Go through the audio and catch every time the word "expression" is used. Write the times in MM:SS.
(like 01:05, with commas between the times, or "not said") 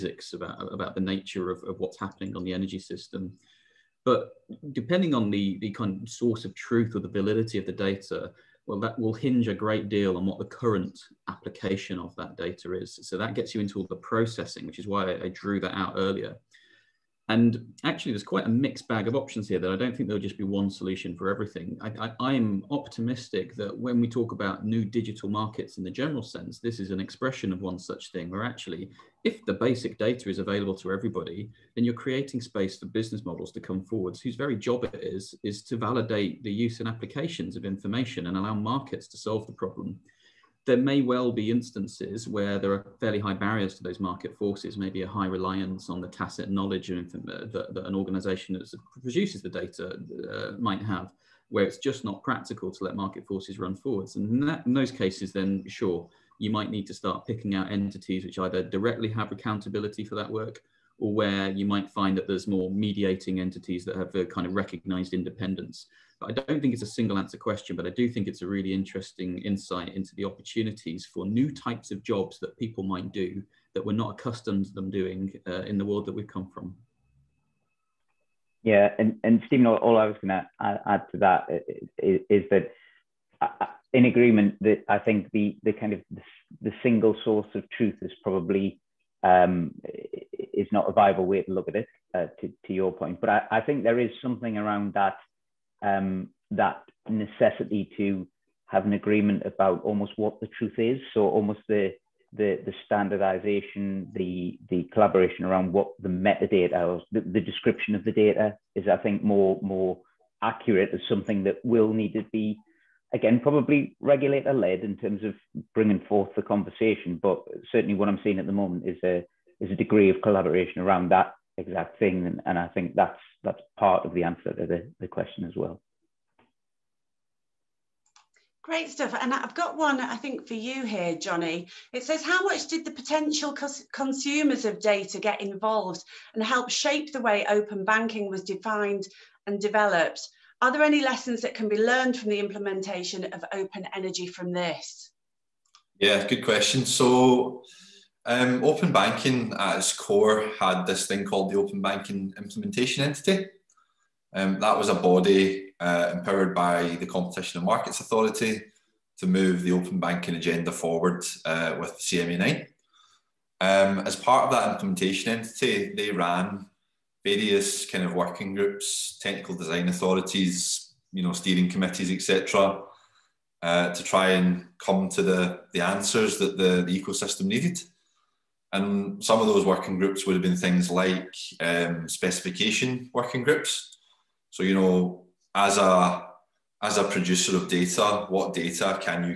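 00:26.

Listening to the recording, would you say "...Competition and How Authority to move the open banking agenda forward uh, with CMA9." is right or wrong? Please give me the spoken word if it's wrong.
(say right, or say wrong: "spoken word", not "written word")
wrong: "Markets", not "How".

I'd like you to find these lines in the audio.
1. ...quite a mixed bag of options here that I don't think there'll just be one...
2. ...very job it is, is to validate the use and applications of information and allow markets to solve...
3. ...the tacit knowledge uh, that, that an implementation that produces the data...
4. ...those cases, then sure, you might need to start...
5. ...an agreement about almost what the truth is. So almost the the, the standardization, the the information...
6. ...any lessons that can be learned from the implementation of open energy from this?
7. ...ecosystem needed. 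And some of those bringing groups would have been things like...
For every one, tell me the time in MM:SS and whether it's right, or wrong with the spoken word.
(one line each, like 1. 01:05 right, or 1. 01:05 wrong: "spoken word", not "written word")
1. 00:18 right
2. 00:34 right
3. 00:46 wrong: "organization", not "implementation"
4. 00:54 right
5. 01:38 wrong: "collaboration", not "information"
6. 02:20 right
7. 02:57 wrong: "working", not "bringing".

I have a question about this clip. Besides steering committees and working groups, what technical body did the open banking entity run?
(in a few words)
technical design authorities.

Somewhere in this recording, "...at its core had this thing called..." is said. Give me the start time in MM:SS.
02:29.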